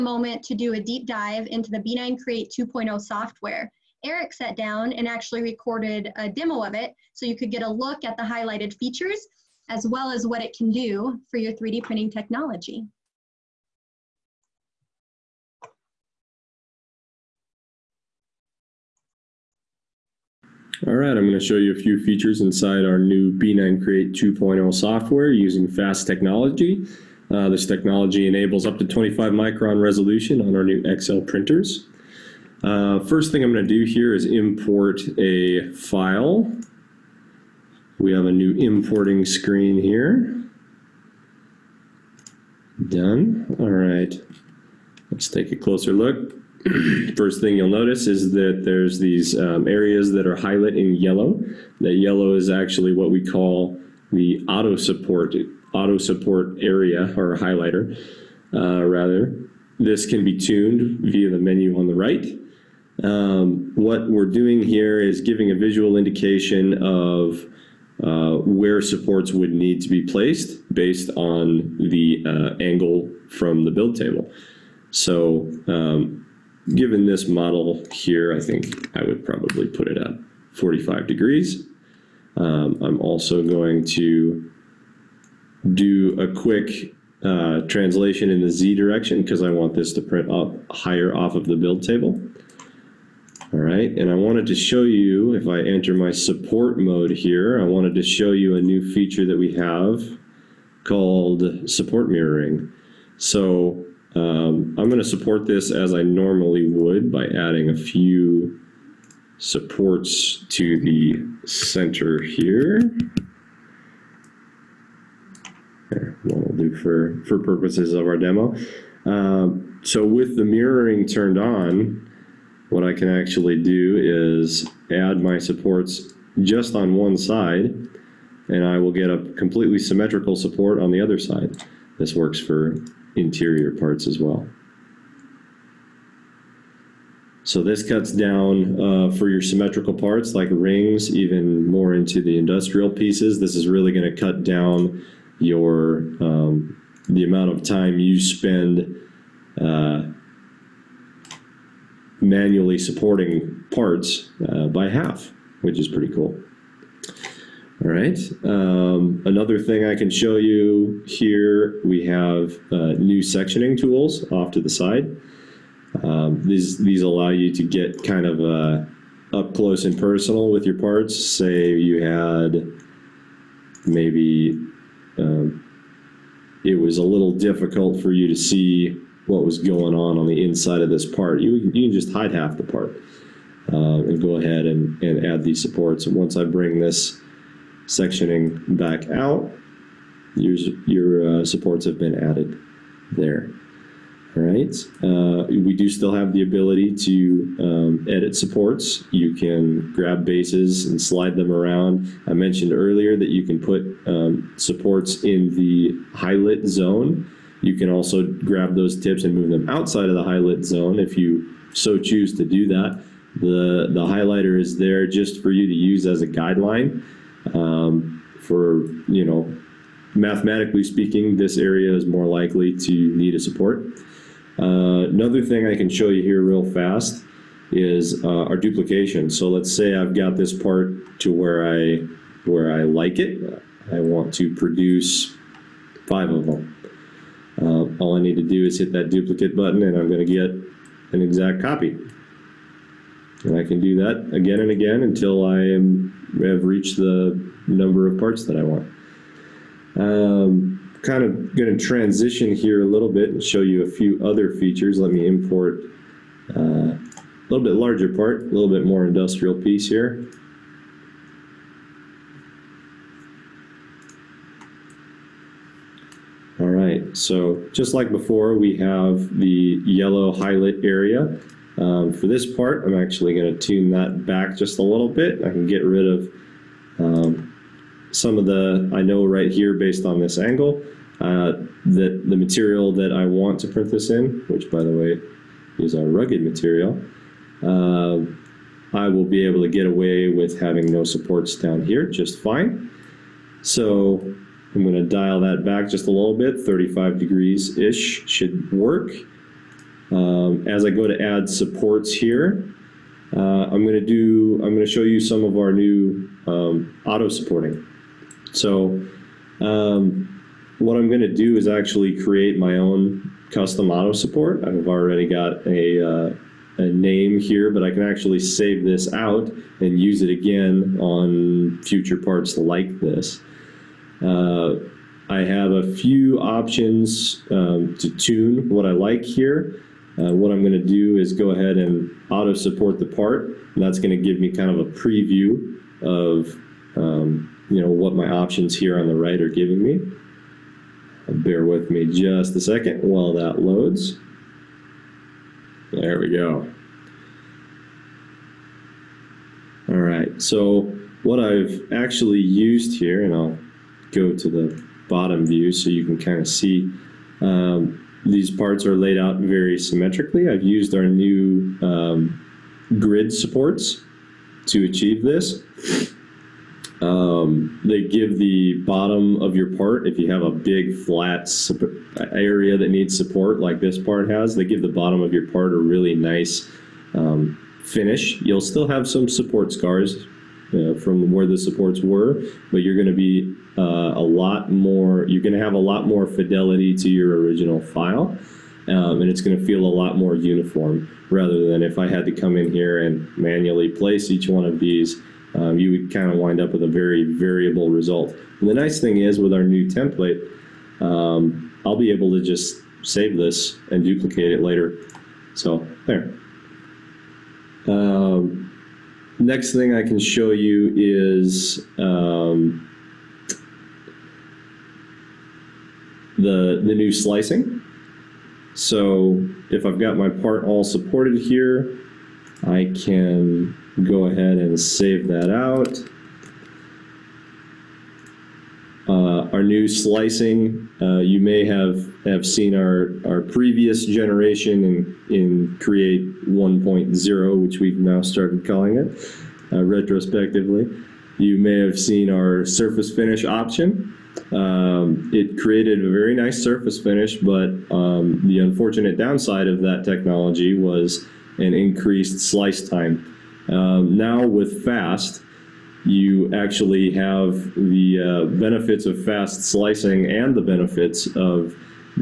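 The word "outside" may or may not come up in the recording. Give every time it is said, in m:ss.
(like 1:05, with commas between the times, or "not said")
3:29.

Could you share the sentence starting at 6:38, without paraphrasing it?
And the nice thing is with our new template, um, I'll be able to just save this and duplicate it later.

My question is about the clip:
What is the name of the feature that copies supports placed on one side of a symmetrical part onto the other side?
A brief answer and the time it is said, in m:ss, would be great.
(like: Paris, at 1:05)
Support mirroring, at 1:41.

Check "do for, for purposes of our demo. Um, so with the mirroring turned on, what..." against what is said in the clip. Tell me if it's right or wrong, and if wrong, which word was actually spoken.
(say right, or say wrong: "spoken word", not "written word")
right.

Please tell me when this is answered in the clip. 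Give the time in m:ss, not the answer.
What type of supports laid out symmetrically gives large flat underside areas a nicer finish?
6:02.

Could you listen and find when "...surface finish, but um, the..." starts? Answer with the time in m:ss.
7:26.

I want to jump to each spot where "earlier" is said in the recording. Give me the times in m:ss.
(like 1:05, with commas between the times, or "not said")
3:22.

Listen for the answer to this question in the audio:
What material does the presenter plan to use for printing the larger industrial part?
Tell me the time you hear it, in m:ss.
4:46.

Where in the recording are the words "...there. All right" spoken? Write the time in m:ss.
3:13.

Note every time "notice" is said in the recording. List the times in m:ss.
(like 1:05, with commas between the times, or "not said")
0:47.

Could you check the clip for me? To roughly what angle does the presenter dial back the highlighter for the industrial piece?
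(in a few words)
35 degrees.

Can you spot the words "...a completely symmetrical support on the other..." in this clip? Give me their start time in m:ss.
2:09.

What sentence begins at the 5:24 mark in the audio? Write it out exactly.
Uh, I have a few options um, to tune what I like here.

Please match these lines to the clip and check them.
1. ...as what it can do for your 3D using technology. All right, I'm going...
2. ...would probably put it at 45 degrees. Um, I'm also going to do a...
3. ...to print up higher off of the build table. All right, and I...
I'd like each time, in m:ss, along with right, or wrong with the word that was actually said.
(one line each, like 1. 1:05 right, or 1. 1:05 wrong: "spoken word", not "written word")
1. 0:10 wrong: "printing", not "using"
2. 1:19 right
3. 1:29 right.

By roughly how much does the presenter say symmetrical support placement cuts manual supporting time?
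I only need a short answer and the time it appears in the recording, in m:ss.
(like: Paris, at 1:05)
By half, at 2:34.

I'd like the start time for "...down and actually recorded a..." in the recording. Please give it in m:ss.
0:04.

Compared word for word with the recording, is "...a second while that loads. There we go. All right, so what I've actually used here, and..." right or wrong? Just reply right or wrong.
right.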